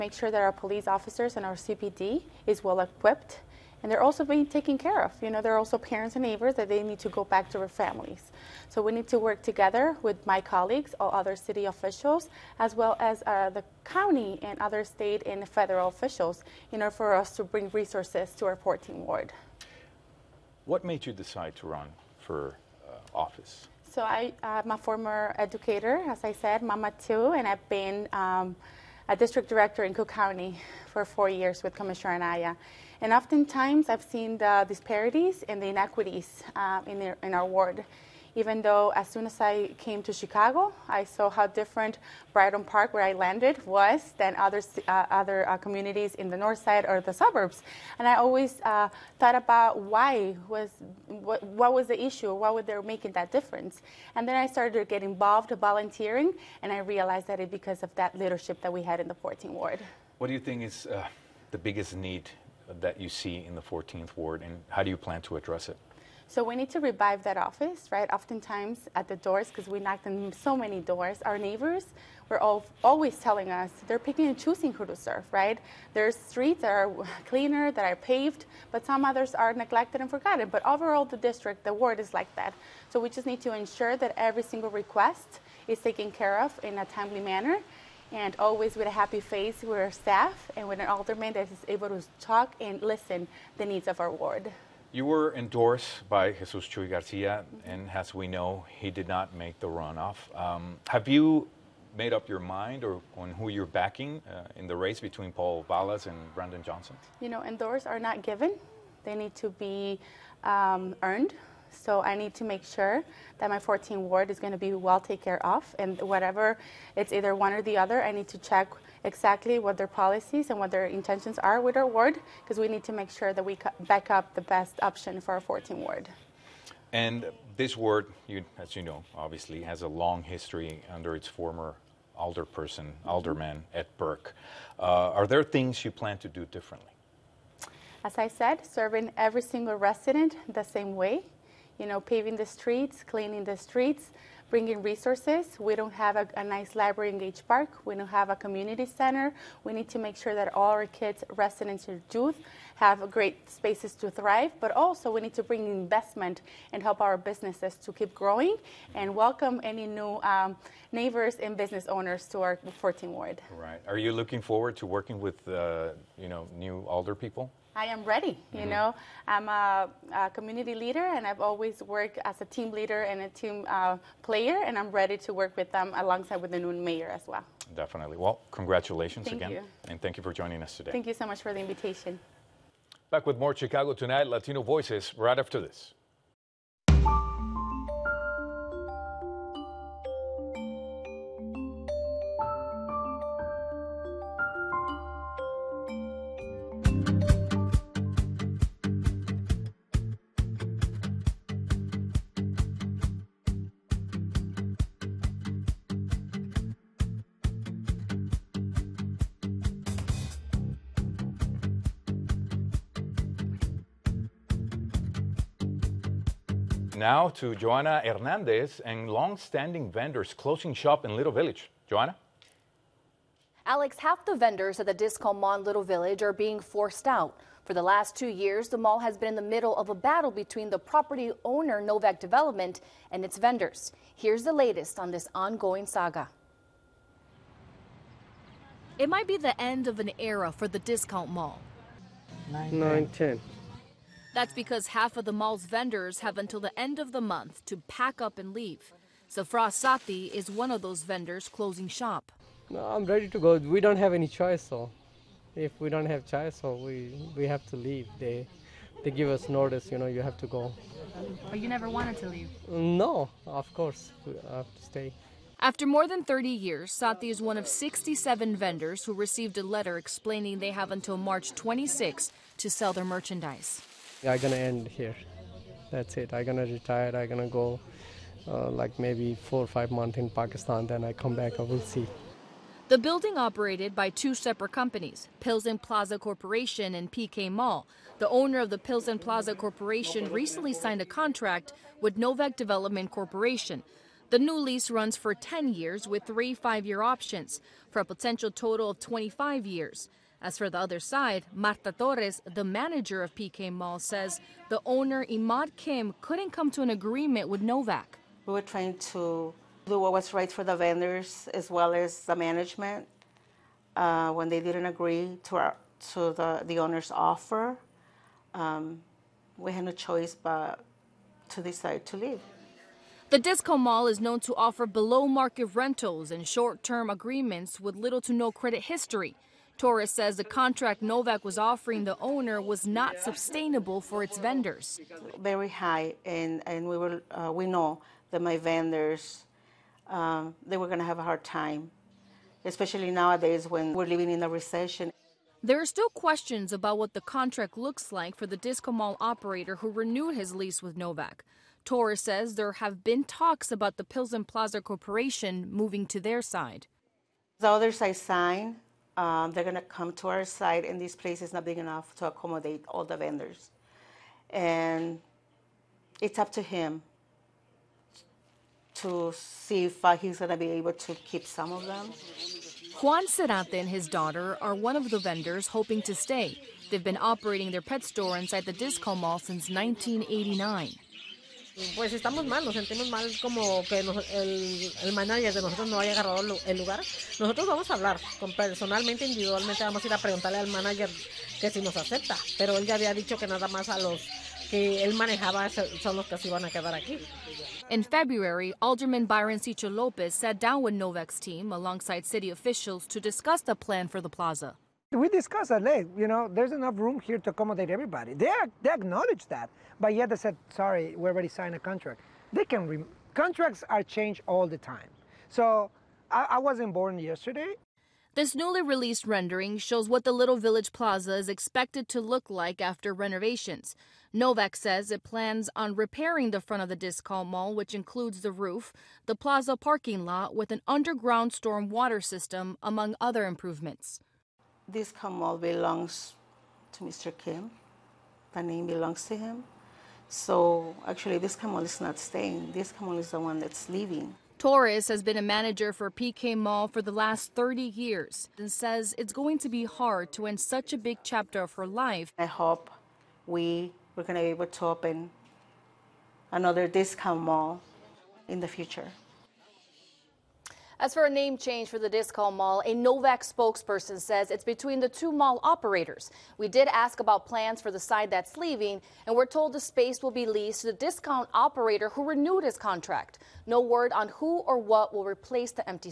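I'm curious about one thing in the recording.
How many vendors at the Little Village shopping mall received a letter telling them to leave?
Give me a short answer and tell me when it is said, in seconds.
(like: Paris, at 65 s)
67, at 267 s.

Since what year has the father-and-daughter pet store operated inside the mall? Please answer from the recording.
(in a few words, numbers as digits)
1989.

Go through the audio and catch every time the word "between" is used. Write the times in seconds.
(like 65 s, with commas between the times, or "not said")
105 s, 230 s, 464 s.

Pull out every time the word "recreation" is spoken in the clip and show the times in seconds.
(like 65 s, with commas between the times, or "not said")
not said.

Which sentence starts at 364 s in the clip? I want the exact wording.
And it's up to him to see if uh, he's going to be able to keep some of them.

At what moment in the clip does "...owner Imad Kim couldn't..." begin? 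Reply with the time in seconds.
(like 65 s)
304 s.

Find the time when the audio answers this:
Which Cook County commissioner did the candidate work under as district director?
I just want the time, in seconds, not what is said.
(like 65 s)
31 s.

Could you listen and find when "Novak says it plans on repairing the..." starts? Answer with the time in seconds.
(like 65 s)
424 s.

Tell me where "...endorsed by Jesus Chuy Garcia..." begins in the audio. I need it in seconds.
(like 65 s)
95 s.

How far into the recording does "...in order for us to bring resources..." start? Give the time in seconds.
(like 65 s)
16 s.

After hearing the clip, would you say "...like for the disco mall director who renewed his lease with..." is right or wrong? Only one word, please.
wrong.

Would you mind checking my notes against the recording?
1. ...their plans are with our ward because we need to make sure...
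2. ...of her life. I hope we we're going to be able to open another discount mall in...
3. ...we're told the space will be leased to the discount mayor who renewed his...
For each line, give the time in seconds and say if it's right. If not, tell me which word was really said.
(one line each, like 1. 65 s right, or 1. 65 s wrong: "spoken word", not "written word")
1. 120 s wrong: "intentions", not "plans"
2. 451 s right
3. 469 s wrong: "operator", not "mayor".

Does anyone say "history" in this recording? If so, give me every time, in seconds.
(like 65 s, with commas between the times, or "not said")
130 s, 328 s.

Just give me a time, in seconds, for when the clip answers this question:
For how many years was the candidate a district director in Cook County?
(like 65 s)
31 s.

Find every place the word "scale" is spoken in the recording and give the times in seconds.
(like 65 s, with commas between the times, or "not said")
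not said.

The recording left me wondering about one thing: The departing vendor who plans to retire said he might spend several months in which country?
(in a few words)
Pakistan.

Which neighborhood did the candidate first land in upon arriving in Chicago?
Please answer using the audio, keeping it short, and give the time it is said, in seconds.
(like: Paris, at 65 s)
Brighton Park, at 42 s.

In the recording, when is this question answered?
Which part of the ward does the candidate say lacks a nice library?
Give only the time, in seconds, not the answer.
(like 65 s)
147 s.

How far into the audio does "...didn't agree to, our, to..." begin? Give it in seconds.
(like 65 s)
314 s.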